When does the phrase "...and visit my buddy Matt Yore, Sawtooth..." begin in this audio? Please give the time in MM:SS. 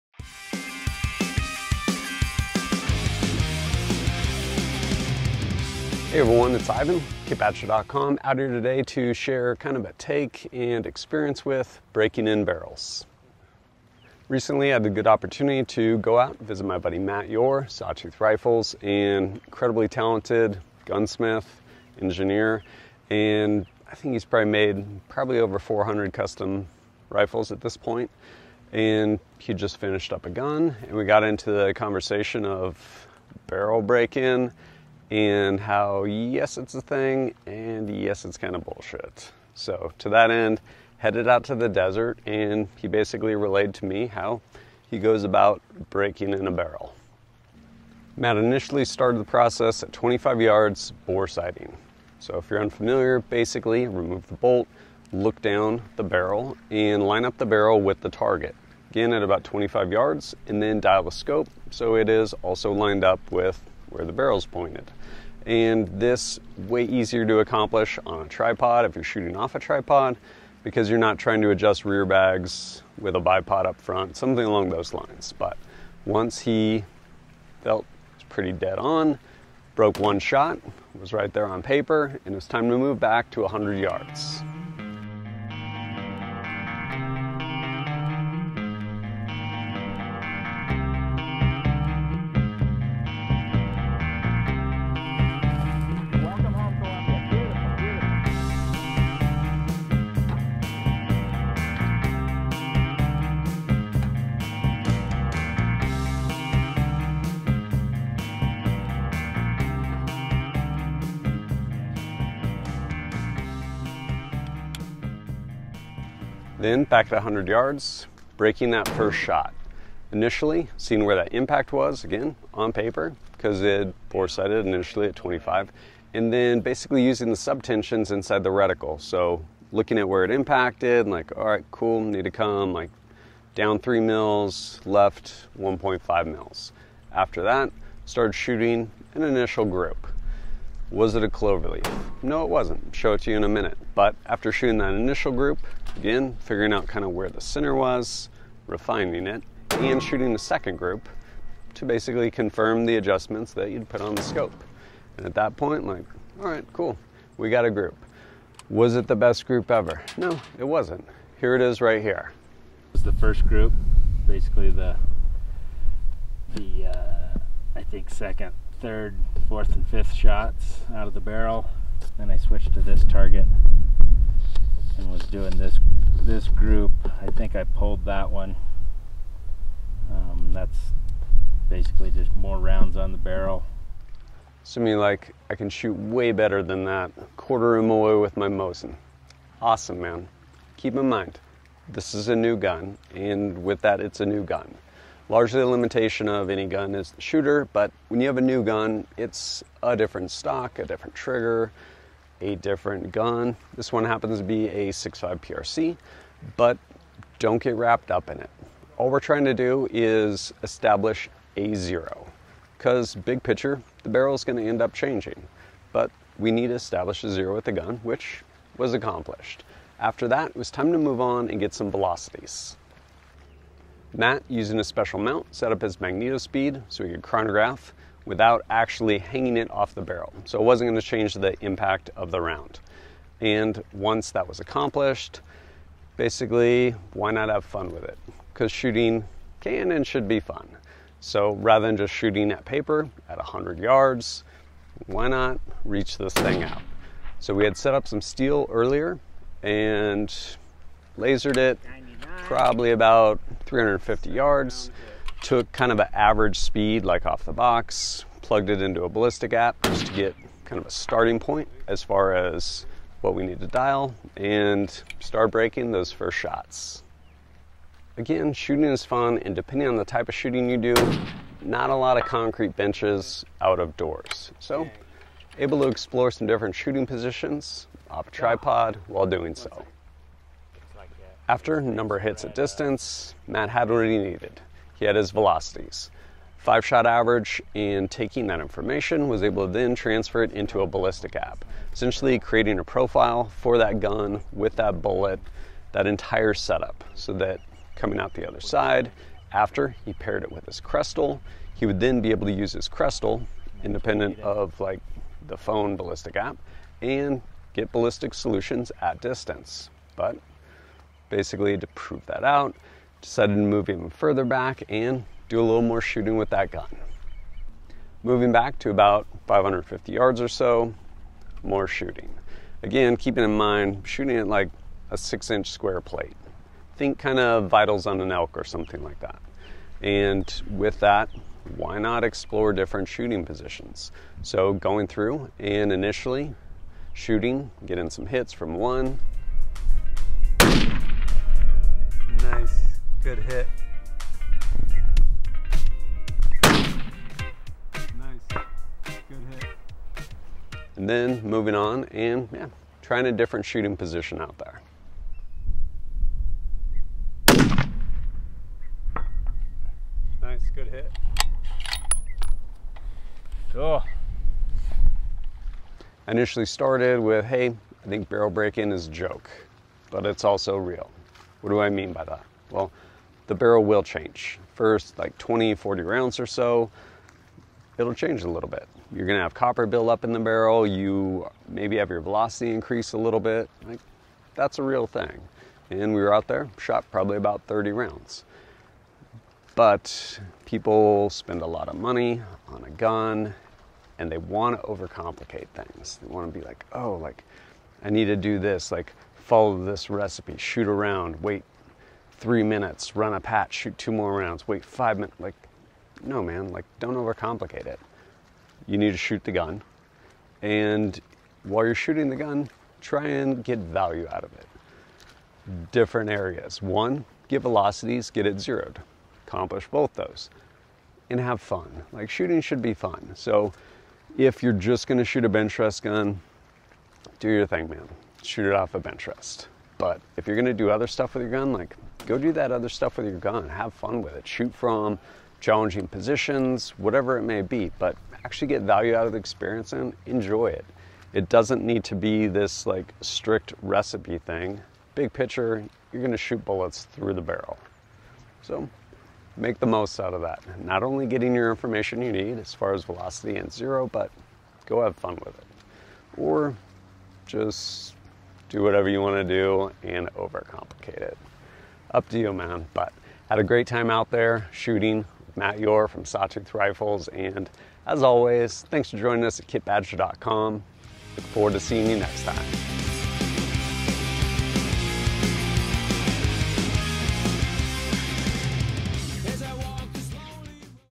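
00:16.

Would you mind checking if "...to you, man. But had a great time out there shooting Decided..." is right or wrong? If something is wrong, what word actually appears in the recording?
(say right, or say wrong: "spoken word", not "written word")
wrong: "Matt", not "Decided".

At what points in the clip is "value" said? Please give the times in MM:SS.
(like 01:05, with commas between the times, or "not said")
06:53, 07:18.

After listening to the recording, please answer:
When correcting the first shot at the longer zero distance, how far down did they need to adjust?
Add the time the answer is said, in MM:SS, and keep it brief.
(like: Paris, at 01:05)
3 mils, at 02:13.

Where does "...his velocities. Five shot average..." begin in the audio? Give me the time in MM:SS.
04:45.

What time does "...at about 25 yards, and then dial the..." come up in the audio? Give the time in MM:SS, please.
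00:59.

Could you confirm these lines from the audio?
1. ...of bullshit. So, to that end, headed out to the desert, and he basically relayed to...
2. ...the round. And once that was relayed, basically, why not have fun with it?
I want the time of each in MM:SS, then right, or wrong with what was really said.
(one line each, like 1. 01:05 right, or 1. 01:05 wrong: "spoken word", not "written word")
1. 00:38 right
2. 03:52 wrong: "accomplished", not "relayed".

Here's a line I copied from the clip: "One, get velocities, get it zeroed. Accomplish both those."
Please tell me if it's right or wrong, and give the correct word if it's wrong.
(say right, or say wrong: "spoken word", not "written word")
right.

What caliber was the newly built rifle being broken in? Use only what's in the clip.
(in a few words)
6.5 PRC.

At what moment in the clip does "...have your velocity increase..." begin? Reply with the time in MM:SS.
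06:21.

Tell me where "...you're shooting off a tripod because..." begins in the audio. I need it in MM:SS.
01:08.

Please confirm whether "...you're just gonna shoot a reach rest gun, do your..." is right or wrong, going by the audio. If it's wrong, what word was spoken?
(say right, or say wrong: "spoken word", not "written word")
wrong: "bench", not "reach".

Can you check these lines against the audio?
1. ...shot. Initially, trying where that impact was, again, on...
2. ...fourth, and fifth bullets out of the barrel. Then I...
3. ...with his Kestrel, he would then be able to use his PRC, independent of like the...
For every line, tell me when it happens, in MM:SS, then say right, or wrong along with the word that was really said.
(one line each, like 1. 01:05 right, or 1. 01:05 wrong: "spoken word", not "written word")
1. 01:59 wrong: "seeing", not "trying"
2. 02:49 wrong: "shots", not "bullets"
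3. 05:00 wrong: "Kestrel", not "PRC".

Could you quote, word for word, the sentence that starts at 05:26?
Think kind of vitals on an elk or something like that.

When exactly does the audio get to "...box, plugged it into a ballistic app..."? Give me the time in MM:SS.
04:17.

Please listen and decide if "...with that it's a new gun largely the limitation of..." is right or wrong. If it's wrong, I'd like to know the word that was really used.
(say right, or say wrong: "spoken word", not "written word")
right.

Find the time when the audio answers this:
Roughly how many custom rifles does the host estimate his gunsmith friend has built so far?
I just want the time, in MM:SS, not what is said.
00:25.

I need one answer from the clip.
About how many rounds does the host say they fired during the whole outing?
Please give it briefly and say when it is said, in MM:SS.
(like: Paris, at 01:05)
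30, at 06:27.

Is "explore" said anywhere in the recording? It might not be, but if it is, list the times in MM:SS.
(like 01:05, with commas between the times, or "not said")
04:35, 05:32.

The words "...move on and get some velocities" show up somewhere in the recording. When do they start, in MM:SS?
03:40.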